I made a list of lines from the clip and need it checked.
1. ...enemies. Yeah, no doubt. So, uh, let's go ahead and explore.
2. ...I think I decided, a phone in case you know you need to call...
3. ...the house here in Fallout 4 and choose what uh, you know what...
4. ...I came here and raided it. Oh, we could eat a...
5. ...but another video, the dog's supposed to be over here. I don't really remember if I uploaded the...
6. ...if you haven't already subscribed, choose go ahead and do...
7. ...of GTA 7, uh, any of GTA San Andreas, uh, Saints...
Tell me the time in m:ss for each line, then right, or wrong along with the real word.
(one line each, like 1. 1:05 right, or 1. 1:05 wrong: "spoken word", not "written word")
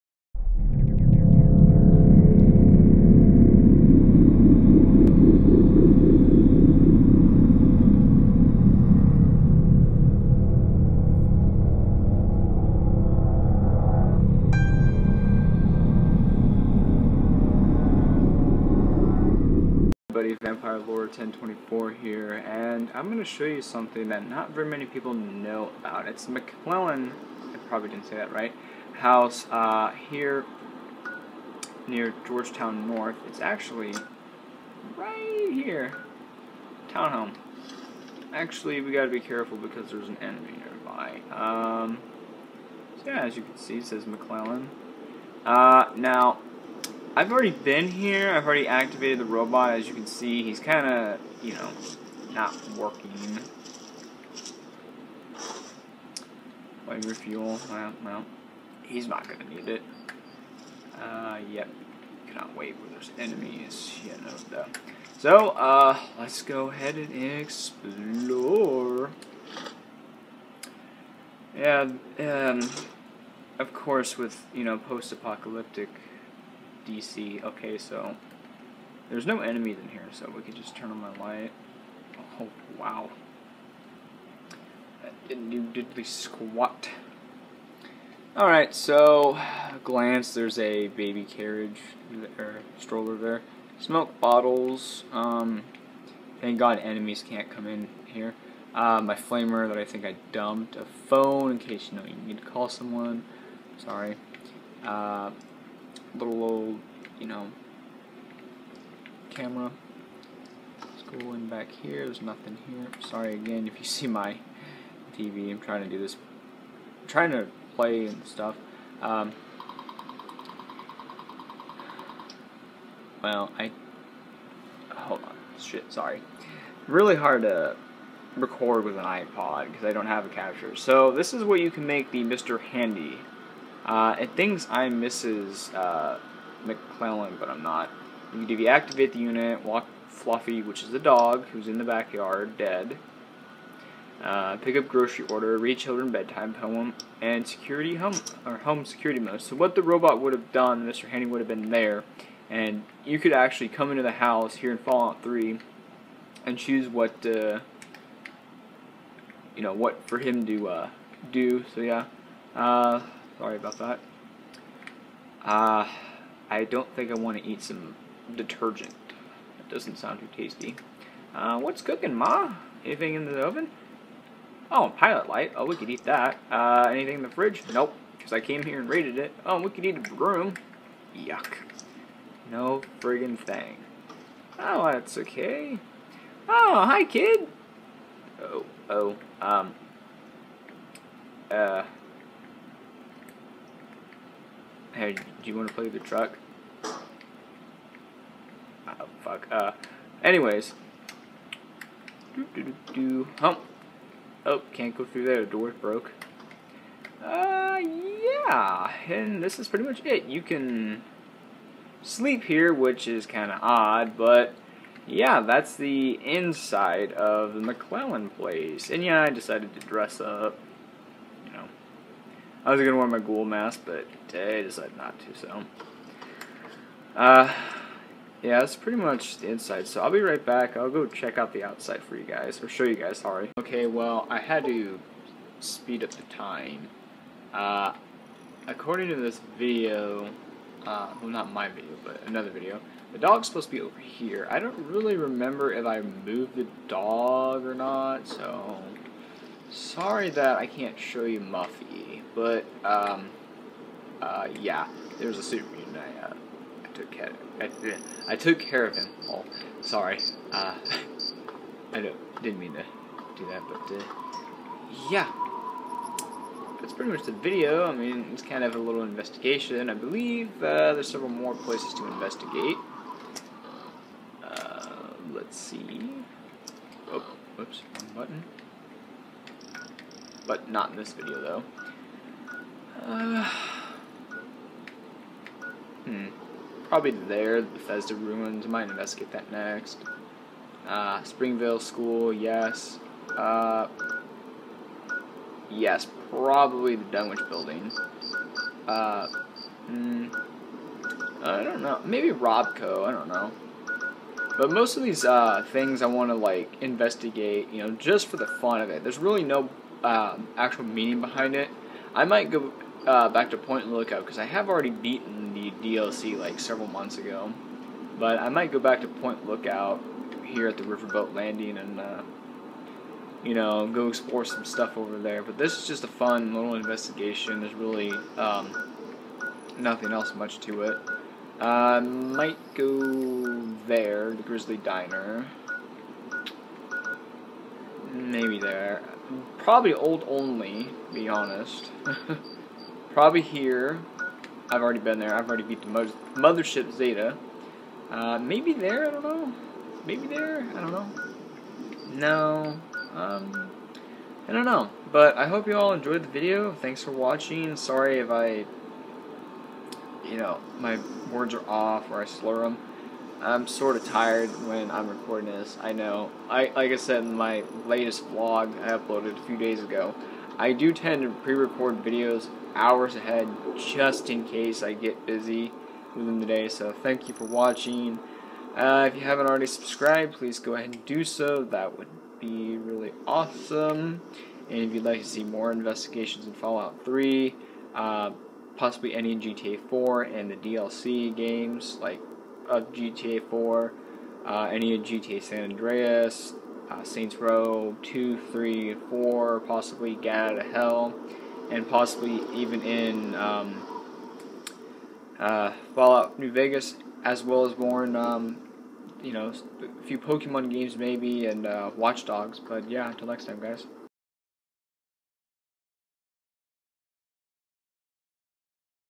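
1. 1:03 right
2. 1:39 wrong: "dumped", not "decided"
3. 2:34 wrong: "3", not "4"
4. 2:58 right
5. 4:02 wrong: "moved", not "uploaded"
6. 6:19 wrong: "please", not "choose"
7. 6:32 wrong: "4", not "7".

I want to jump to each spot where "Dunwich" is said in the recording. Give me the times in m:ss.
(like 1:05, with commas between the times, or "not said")
4:57.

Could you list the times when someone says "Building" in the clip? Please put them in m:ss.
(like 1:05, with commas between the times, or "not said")
4:57.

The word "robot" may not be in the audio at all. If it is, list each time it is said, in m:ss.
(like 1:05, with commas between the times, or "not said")
0:49, 2:29.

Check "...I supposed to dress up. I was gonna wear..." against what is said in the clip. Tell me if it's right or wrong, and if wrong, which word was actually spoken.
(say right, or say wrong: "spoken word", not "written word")
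wrong: "decided", not "supposed".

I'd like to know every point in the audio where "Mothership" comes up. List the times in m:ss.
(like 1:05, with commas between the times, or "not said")
5:46.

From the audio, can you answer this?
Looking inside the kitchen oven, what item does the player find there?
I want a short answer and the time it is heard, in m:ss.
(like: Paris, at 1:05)
Pilot light, at 2:54.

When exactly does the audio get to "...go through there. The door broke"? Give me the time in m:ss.
3:24.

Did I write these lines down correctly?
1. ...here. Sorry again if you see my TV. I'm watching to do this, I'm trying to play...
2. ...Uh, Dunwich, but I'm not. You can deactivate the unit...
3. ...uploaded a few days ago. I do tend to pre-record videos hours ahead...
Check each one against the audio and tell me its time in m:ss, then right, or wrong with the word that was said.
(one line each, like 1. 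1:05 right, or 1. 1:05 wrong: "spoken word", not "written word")
1. 1:52 wrong: "trying", not "watching"
2. 2:15 wrong: "McClellan", not "Dunwich"
3. 6:08 right.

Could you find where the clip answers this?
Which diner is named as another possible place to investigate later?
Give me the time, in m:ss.
5:34.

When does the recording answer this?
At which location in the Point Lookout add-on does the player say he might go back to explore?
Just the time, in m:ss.
5:20.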